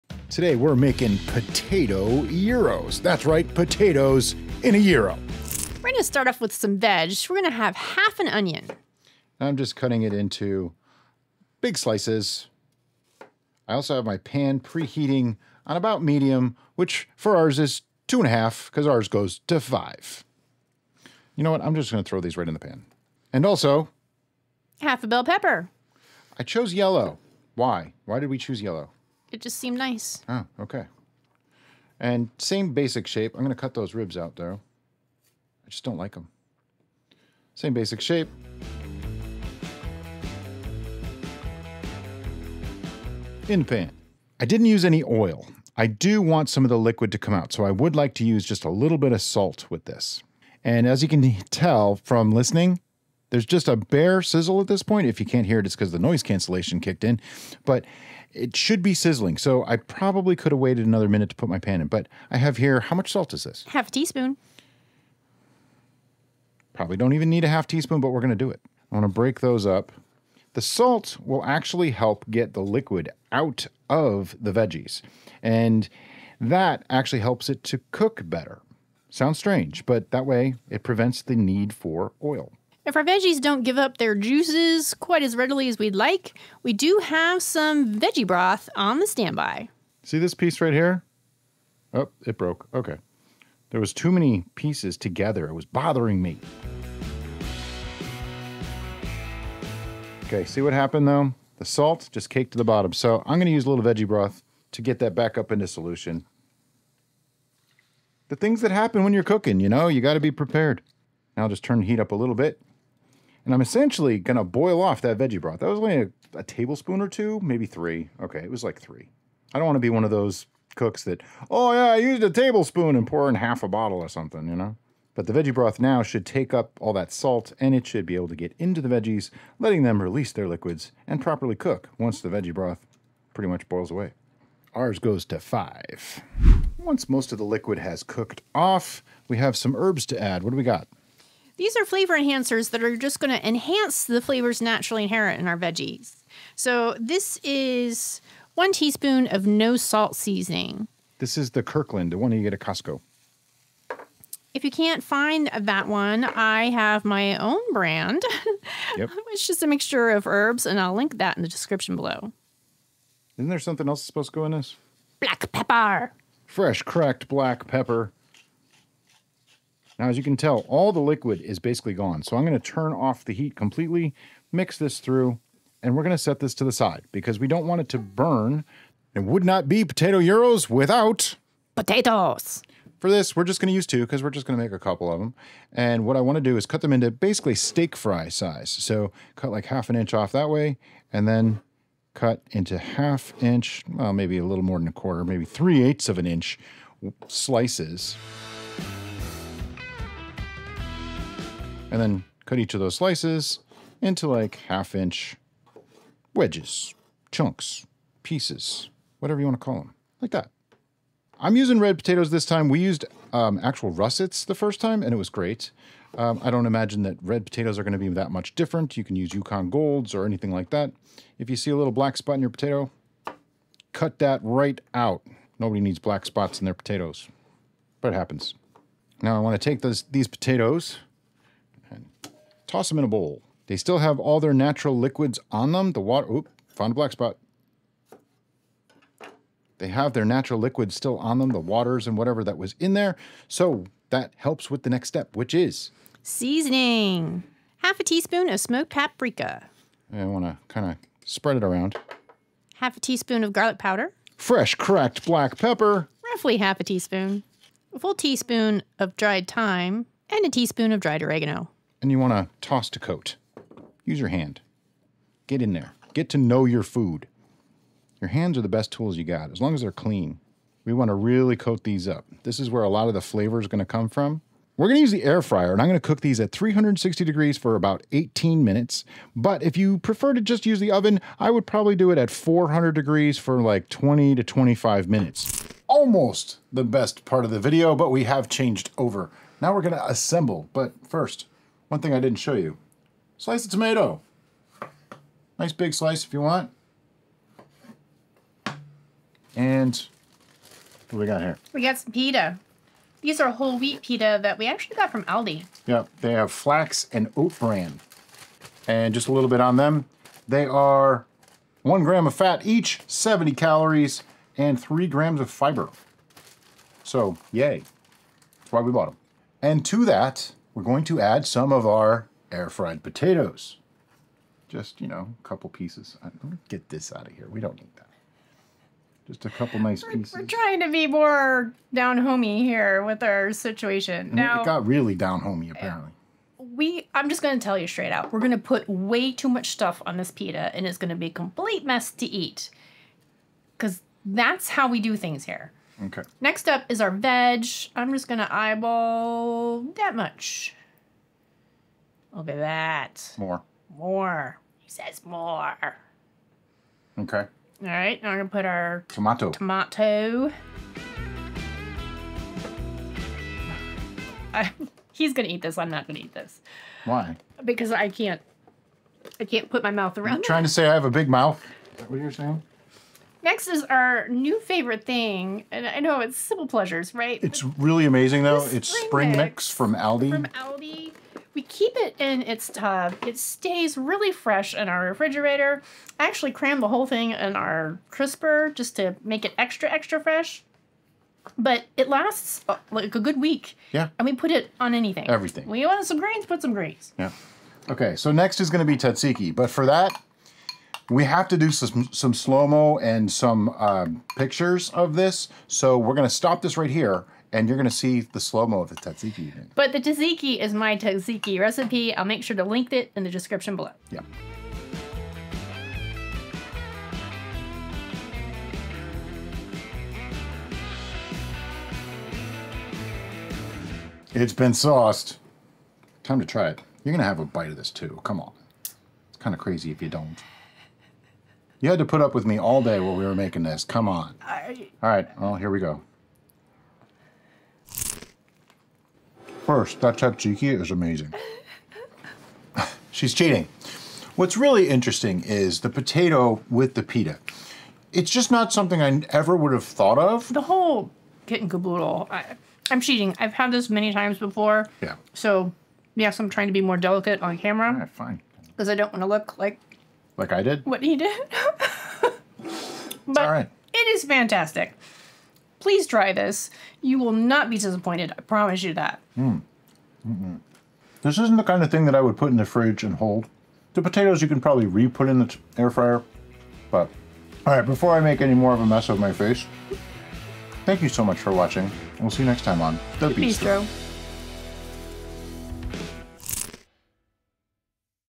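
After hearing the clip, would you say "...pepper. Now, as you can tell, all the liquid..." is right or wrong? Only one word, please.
right.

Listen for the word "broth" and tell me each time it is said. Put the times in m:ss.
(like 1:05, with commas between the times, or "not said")
1:28, 1:44, 1:55, 2:05, 2:12.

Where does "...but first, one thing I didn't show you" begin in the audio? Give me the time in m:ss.
4:50.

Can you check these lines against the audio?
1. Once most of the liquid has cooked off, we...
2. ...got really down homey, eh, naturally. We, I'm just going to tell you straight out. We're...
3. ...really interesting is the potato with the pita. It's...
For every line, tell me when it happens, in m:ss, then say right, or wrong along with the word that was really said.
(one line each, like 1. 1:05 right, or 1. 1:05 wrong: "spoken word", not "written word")
1. 2:16 right
2. 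5:34 wrong: "apparently", not "naturally"
3. 7:24 right.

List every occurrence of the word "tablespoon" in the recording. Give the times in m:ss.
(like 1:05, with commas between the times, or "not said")
1:56, 2:02.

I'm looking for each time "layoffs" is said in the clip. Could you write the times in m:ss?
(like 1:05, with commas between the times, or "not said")
not said.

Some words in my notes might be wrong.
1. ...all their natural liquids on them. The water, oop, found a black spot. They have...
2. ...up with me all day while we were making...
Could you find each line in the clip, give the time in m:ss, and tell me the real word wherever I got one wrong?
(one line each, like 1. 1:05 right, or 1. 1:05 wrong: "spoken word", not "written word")
1. 3:54 right
2. 7:12 right.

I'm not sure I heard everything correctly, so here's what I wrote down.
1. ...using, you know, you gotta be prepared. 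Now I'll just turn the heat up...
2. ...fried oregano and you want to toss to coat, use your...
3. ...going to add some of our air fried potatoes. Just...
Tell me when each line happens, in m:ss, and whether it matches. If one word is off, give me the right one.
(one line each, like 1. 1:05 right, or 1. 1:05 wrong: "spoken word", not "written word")
1. 1:49 wrong: "cooking", not "using"
2. 4:21 wrong: "dried", not "fried"
3. 5:20 right.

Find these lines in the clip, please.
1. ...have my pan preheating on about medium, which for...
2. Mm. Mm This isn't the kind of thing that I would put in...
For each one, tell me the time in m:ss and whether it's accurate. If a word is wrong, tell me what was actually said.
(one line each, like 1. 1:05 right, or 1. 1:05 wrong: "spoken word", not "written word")
1. 0:13 right
2. 7:49 right.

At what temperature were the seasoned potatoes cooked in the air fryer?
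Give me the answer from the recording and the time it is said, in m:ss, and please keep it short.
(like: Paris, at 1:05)
360 degrees, at 4:36.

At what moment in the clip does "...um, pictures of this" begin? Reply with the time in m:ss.
6:43.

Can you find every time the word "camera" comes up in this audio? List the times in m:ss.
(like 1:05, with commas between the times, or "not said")
7:37.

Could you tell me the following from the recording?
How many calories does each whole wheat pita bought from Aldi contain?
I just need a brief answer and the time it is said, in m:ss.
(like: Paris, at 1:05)
70, at 5:13.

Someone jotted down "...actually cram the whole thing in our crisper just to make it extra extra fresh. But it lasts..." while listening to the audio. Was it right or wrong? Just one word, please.
right.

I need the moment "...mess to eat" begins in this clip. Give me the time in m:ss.
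5:41.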